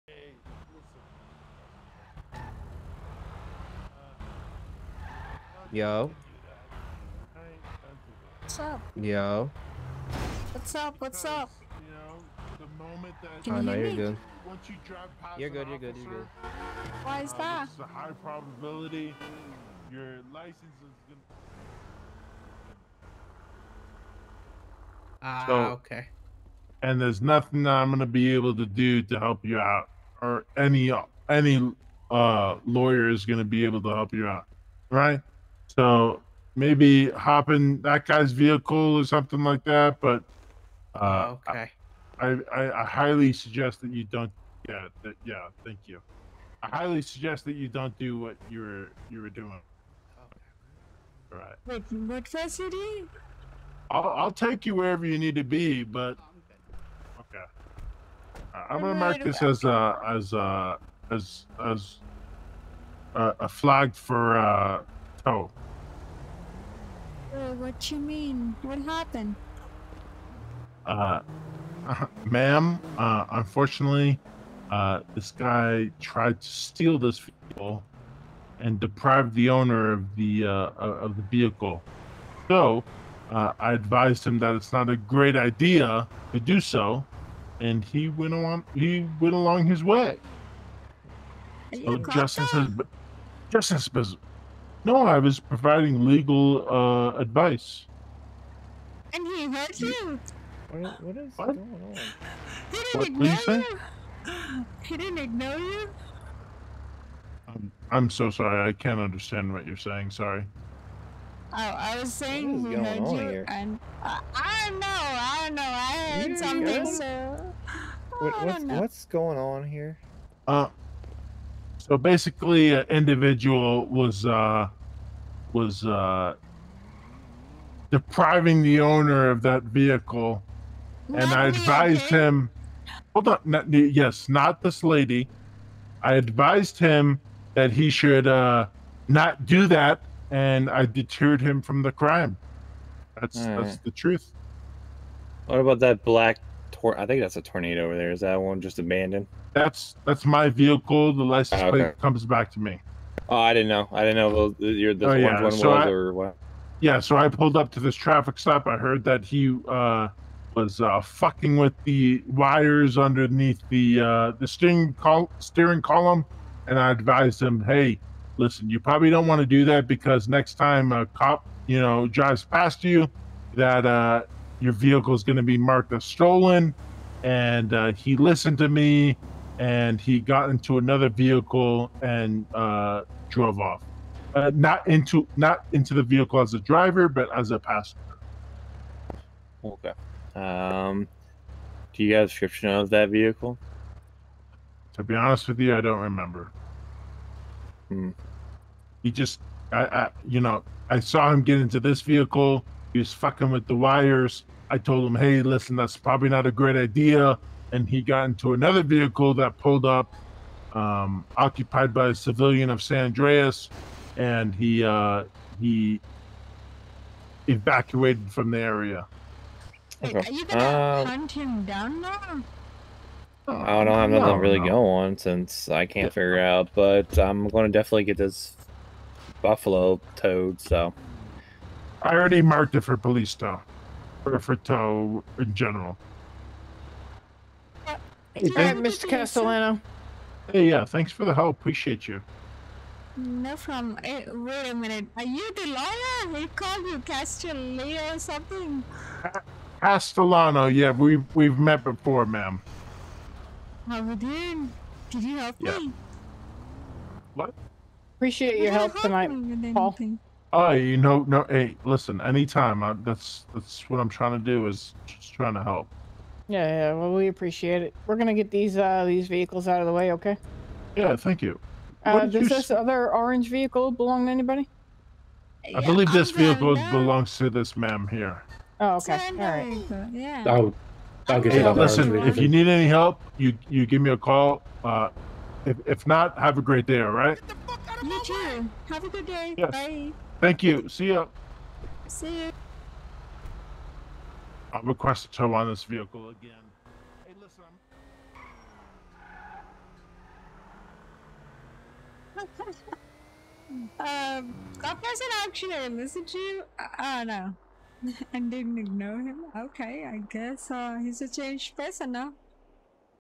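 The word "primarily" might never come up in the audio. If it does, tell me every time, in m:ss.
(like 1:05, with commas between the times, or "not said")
not said.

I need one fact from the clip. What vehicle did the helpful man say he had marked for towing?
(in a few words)
Buffalo.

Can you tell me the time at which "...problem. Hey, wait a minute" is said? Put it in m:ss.
4:03.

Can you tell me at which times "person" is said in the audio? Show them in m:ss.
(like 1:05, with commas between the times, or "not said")
5:05, 5:11.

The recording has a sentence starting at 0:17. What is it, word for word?
It's a high probability your license is gonna.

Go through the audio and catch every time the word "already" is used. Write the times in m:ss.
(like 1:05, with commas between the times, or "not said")
3:52.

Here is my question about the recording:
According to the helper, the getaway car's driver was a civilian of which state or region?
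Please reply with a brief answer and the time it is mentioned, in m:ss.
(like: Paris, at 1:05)
San Andreas, at 3:32.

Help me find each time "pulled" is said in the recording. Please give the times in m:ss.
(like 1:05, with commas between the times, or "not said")
2:37, 3:29.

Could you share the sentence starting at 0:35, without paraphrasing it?
So maybe hop in that guy's vehicle or something like that.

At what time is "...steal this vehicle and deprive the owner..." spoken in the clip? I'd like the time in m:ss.
1:16.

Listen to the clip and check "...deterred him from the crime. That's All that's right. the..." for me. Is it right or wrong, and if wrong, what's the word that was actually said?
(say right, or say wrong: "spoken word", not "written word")
right.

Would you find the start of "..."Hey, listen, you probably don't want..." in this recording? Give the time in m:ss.
2:47.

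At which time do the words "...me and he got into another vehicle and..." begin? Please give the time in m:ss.
2:58.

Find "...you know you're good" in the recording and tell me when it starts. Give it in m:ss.
0:13.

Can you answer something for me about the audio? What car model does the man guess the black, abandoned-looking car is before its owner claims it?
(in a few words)
Tornado.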